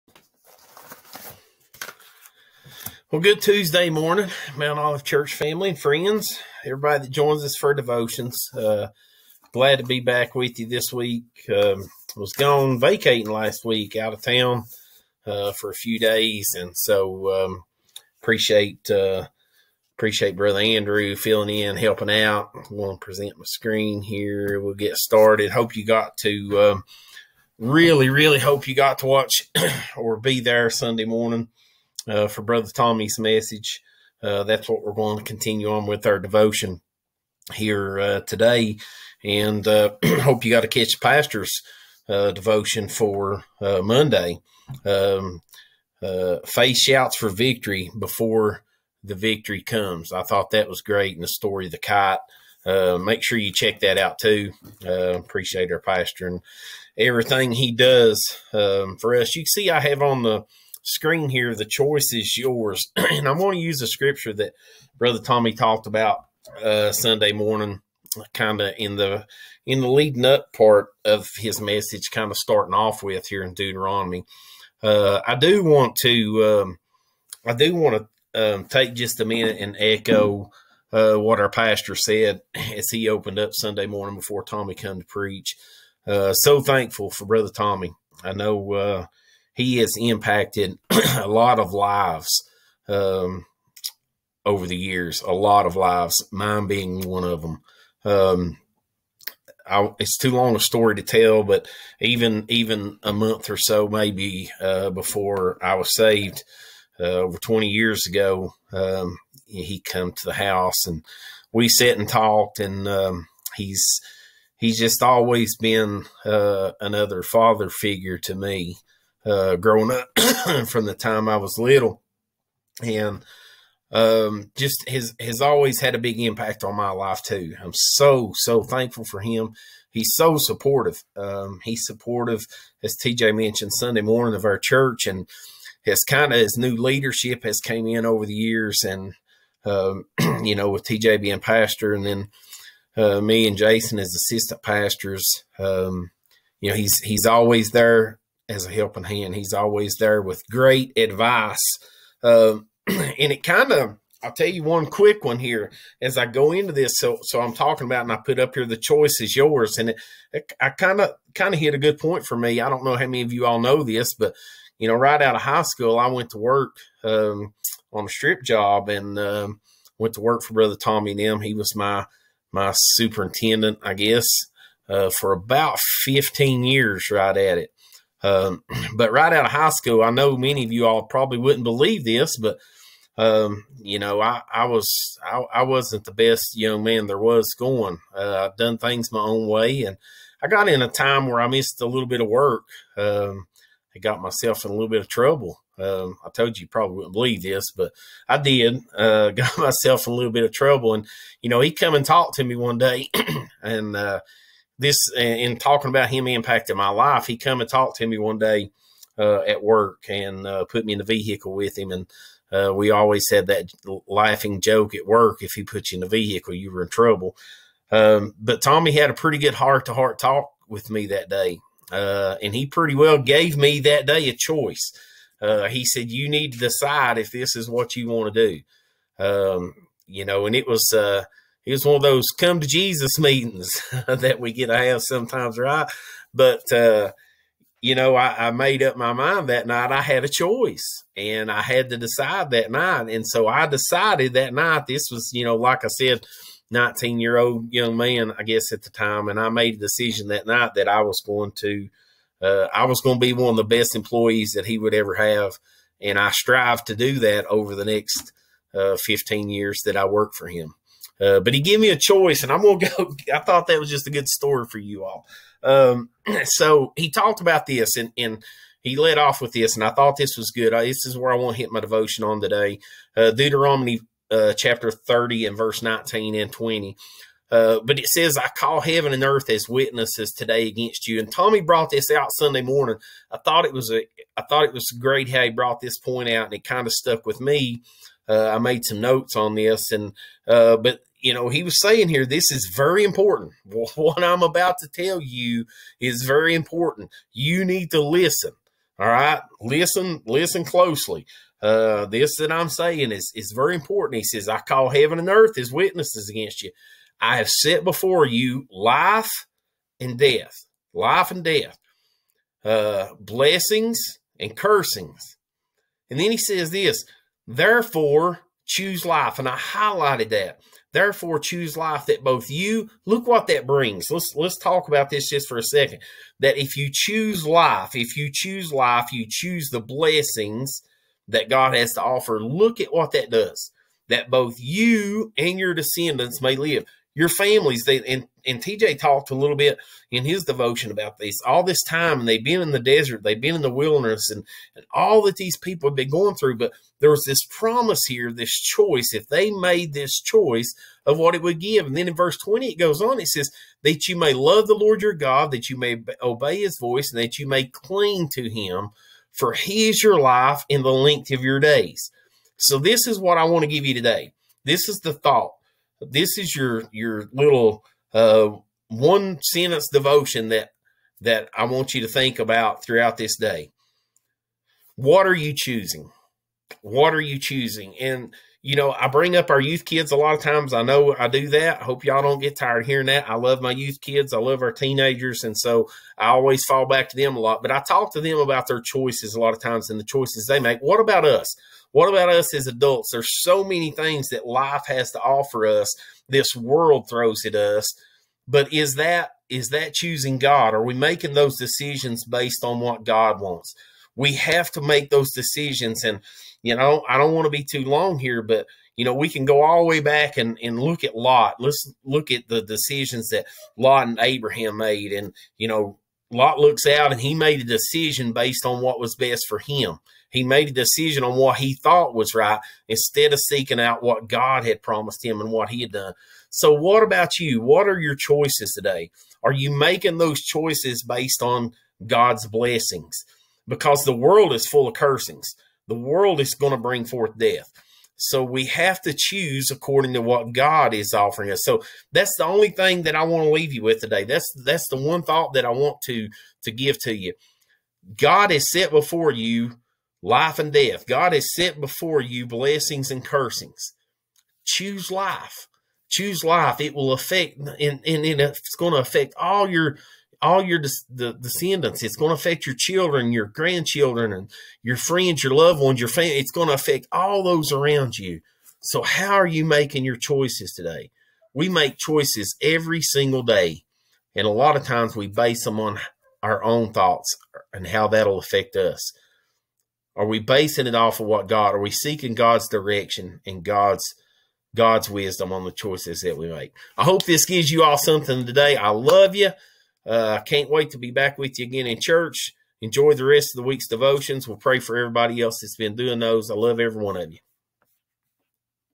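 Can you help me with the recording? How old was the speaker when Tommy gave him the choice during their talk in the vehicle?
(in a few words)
nineteen-year-old.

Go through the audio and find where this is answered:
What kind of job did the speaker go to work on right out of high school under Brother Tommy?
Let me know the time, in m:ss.
2:48.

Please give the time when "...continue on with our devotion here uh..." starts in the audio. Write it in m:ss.
0:35.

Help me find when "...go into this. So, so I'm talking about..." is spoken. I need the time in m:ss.
2:36.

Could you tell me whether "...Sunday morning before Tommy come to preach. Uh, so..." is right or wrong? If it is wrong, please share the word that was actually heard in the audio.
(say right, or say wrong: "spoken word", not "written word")
right.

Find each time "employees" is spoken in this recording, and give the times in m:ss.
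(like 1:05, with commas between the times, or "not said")
4:13.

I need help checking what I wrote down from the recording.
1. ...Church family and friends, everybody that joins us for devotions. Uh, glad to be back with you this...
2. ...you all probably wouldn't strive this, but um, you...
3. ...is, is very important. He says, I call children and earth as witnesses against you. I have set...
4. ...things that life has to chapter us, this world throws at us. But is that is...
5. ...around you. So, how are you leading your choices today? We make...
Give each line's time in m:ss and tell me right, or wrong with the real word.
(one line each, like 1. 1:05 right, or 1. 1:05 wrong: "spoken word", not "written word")
1. 0:05 right
2. 3:00 wrong: "believe", not "strive"
3. 5:03 wrong: "heaven", not "children"
4. 6:33 wrong: "offer", not "chapter"
5. 7:47 wrong: "making", not "leading".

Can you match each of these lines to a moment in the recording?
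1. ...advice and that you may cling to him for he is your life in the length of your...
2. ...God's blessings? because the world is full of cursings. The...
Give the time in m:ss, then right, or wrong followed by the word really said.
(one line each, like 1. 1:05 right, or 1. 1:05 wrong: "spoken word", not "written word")
1. 5:56 wrong: "voice", not "advice"
2. 7:12 right.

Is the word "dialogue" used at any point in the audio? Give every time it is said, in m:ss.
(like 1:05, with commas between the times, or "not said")
not said.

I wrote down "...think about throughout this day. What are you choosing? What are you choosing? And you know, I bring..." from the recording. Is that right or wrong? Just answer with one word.
right.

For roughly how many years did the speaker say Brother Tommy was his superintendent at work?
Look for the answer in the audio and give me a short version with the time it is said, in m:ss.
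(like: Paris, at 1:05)
15, at 2:55.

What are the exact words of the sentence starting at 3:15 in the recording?
Um, I told you, you probably wouldn't believe this, but I did.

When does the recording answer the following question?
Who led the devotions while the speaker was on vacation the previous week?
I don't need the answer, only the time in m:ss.
0:20.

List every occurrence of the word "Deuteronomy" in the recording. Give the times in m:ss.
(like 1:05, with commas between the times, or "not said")
1:13, 4:33.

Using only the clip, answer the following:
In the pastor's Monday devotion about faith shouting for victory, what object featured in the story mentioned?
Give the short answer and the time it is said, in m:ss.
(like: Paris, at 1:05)
kite, at 0:51.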